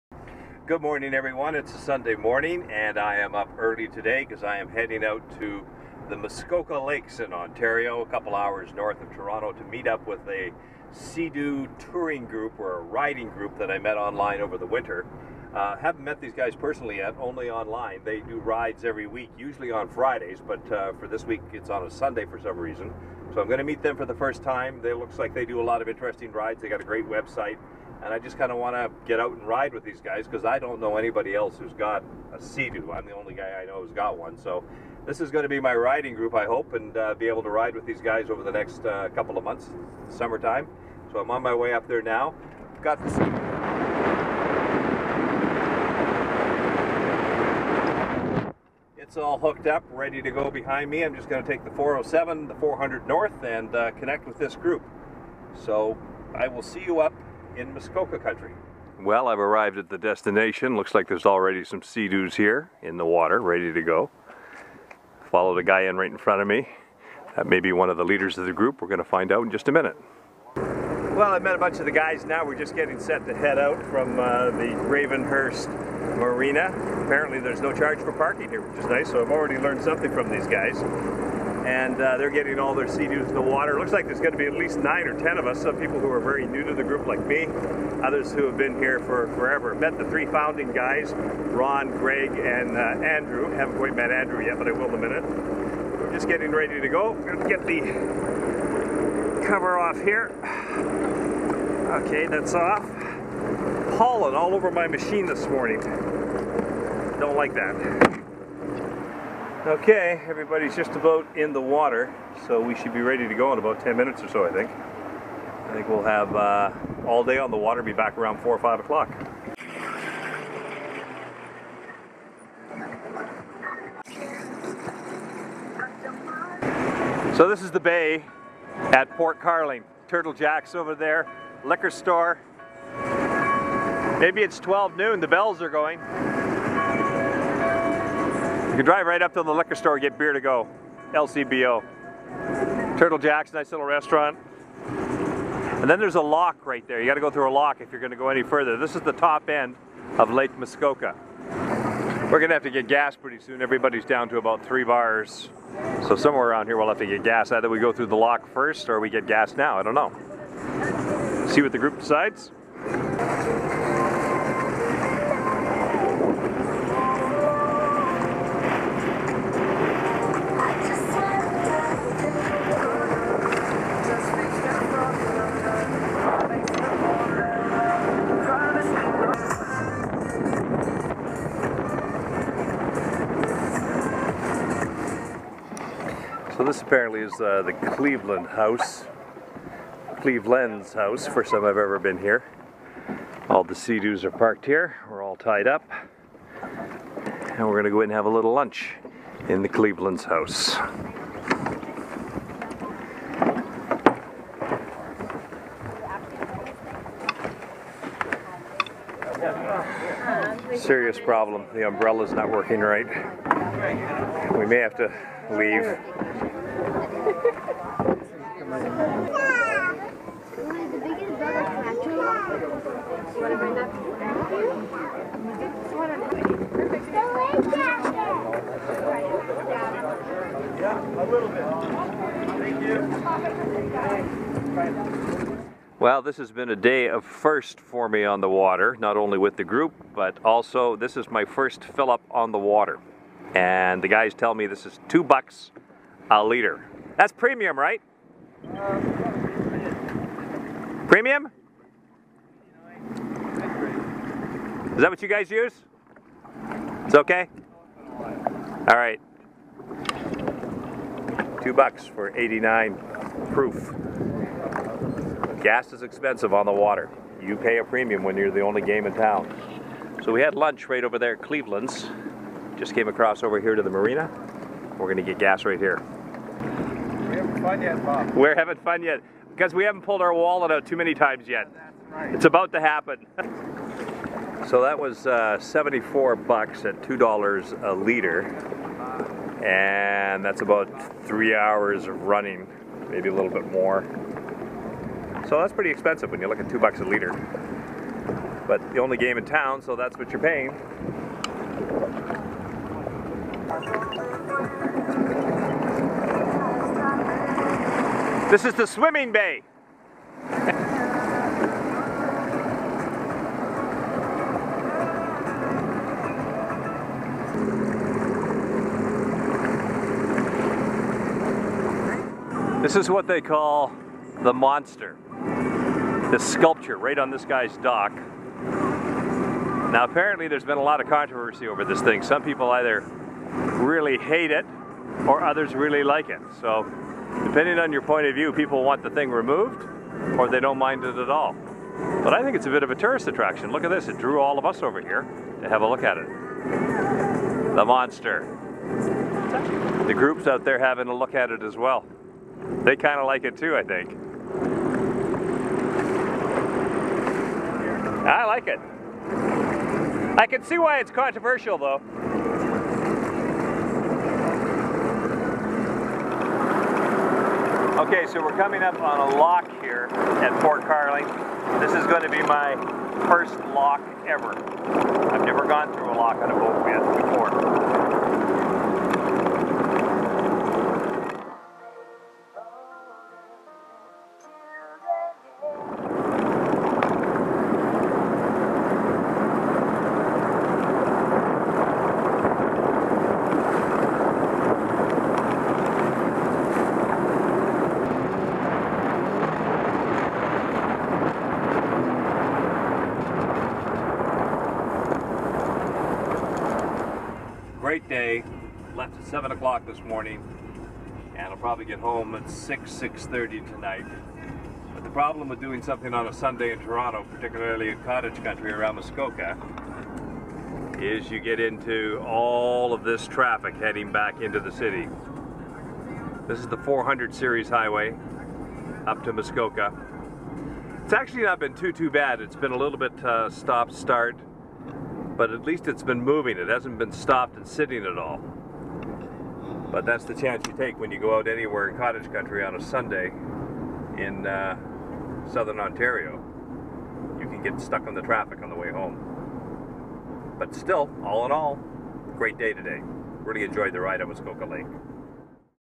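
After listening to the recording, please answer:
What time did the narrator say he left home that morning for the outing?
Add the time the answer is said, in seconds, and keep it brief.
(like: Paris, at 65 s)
7 o'clock, at 409 s.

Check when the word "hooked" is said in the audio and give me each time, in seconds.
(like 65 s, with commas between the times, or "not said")
49 s.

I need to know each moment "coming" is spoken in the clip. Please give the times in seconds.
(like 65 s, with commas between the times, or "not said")
368 s.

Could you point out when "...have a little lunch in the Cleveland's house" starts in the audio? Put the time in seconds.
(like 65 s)
198 s.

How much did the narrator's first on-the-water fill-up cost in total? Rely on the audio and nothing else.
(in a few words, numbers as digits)
$74.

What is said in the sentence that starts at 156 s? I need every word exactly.
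So somewhere around here we'll have to get gas.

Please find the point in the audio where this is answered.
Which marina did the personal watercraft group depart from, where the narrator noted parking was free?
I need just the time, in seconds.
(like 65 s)
74 s.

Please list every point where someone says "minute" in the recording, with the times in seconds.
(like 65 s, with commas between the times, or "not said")
69 s, 94 s, 113 s.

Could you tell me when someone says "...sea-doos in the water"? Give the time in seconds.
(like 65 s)
82 s.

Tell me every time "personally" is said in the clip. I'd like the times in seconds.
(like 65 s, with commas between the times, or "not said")
16 s.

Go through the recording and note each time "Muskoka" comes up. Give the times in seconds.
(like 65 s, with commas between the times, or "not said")
6 s, 57 s, 150 s, 418 s, 429 s, 454 s.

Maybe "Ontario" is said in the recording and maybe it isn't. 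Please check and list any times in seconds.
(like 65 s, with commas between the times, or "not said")
7 s, 445 s.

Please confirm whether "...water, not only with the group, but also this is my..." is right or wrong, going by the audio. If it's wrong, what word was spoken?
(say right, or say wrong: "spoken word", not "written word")
right.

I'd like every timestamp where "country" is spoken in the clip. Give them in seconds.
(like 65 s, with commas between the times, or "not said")
58 s, 418 s, 442 s.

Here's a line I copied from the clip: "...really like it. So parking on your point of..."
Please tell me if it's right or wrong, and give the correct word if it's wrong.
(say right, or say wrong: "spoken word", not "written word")
wrong: "depending", not "parking".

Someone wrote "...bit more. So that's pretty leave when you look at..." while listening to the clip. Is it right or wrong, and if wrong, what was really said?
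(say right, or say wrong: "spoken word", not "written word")
wrong: "expensive", not "leave".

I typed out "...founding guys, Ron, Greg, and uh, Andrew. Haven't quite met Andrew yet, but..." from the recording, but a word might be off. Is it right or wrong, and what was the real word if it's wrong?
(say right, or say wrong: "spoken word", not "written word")
right.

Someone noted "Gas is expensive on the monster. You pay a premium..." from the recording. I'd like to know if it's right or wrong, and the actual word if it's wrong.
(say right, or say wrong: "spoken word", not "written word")
wrong: "water", not "monster".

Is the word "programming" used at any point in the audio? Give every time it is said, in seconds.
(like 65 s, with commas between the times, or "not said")
not said.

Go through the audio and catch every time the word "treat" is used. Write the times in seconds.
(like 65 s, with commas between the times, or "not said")
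not said.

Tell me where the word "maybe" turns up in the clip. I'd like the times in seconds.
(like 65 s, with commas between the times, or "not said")
134 s, 293 s.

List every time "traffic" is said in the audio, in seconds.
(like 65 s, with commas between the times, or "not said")
423 s, 448 s.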